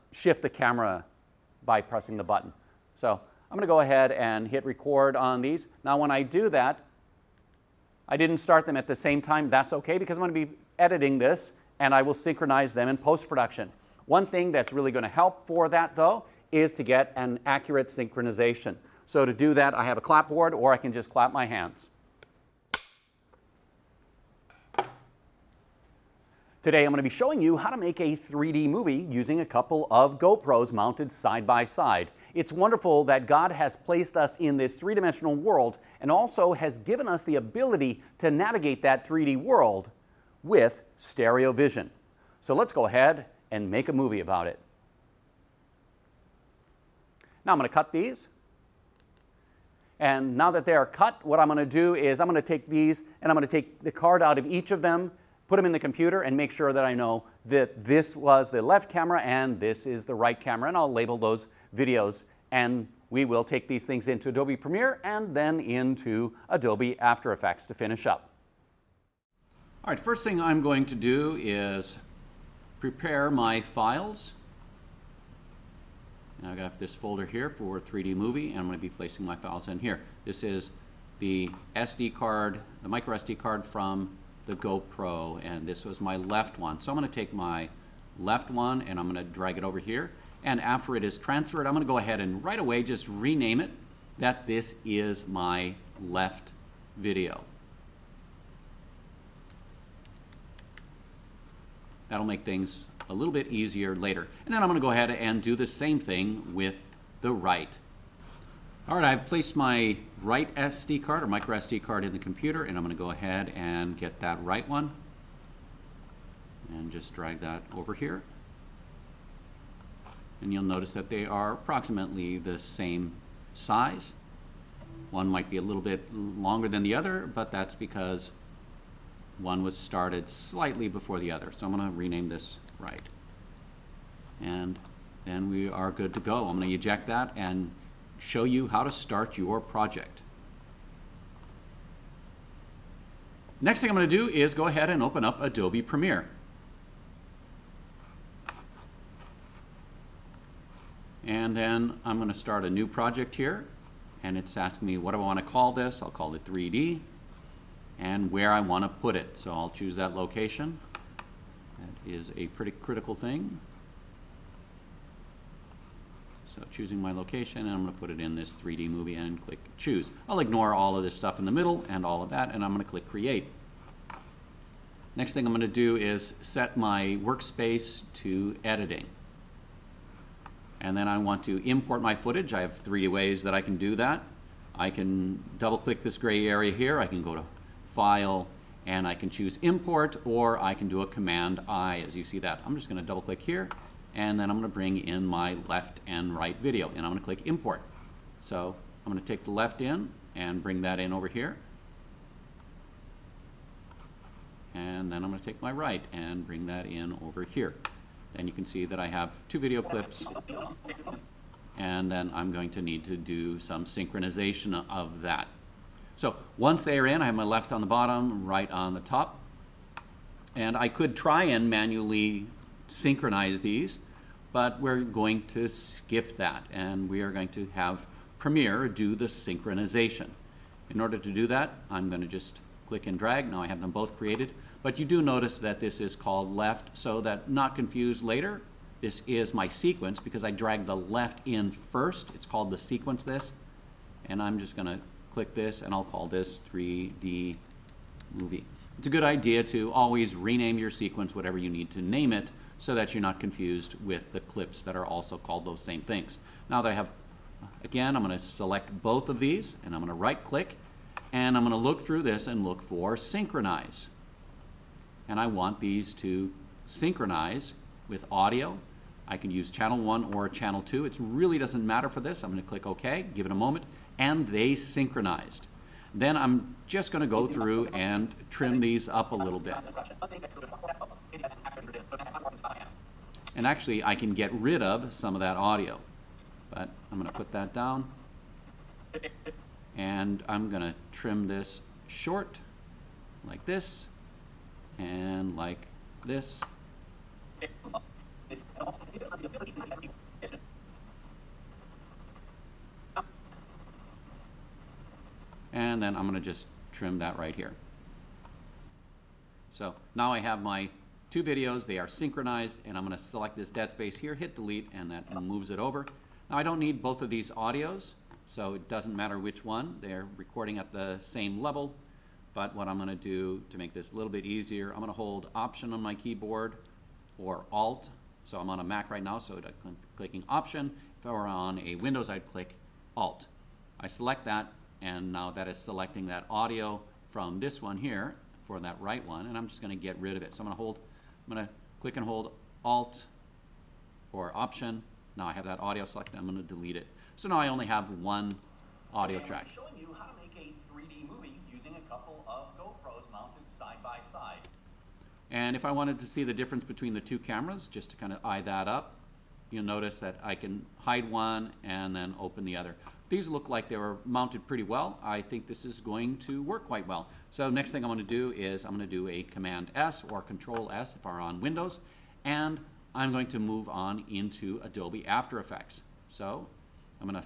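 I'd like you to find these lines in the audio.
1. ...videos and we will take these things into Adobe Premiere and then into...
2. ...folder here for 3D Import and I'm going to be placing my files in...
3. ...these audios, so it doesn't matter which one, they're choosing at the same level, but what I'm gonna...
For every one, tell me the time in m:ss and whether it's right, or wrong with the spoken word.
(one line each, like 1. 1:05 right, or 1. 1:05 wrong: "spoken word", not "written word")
1. 1:01 right
2. 1:16 wrong: "Movie", not "Import"
3. 5:17 wrong: "recording", not "choosing".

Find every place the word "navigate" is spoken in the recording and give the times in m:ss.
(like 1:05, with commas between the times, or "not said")
0:38.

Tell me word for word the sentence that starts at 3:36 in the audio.
So once they are in, I have my left on the bottom, right on the top.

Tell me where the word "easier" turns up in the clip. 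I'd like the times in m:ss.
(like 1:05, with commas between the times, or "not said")
1:43, 5:24.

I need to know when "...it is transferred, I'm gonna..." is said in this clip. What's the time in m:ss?
1:30.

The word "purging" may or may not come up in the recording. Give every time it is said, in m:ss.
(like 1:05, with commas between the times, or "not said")
not said.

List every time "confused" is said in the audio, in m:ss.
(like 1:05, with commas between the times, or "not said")
3:57, 4:13.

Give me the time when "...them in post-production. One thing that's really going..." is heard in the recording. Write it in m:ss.
0:12.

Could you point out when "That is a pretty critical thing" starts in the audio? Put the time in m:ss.
2:41.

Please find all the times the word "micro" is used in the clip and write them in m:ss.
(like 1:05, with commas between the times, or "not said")
1:22, 1:51.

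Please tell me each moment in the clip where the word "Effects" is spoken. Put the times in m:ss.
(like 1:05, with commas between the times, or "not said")
1:07, 6:15.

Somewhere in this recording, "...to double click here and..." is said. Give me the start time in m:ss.
3:13.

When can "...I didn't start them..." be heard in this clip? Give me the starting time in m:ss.
0:08.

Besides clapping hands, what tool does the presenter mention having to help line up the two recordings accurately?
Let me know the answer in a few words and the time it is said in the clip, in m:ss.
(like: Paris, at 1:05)
clapboard, at 0:20.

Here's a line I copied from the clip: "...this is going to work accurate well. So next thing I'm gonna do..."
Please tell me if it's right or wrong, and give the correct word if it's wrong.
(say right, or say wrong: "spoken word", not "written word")
wrong: "quite", not "accurate".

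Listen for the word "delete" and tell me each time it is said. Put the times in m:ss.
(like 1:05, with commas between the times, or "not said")
5:14, 5:46.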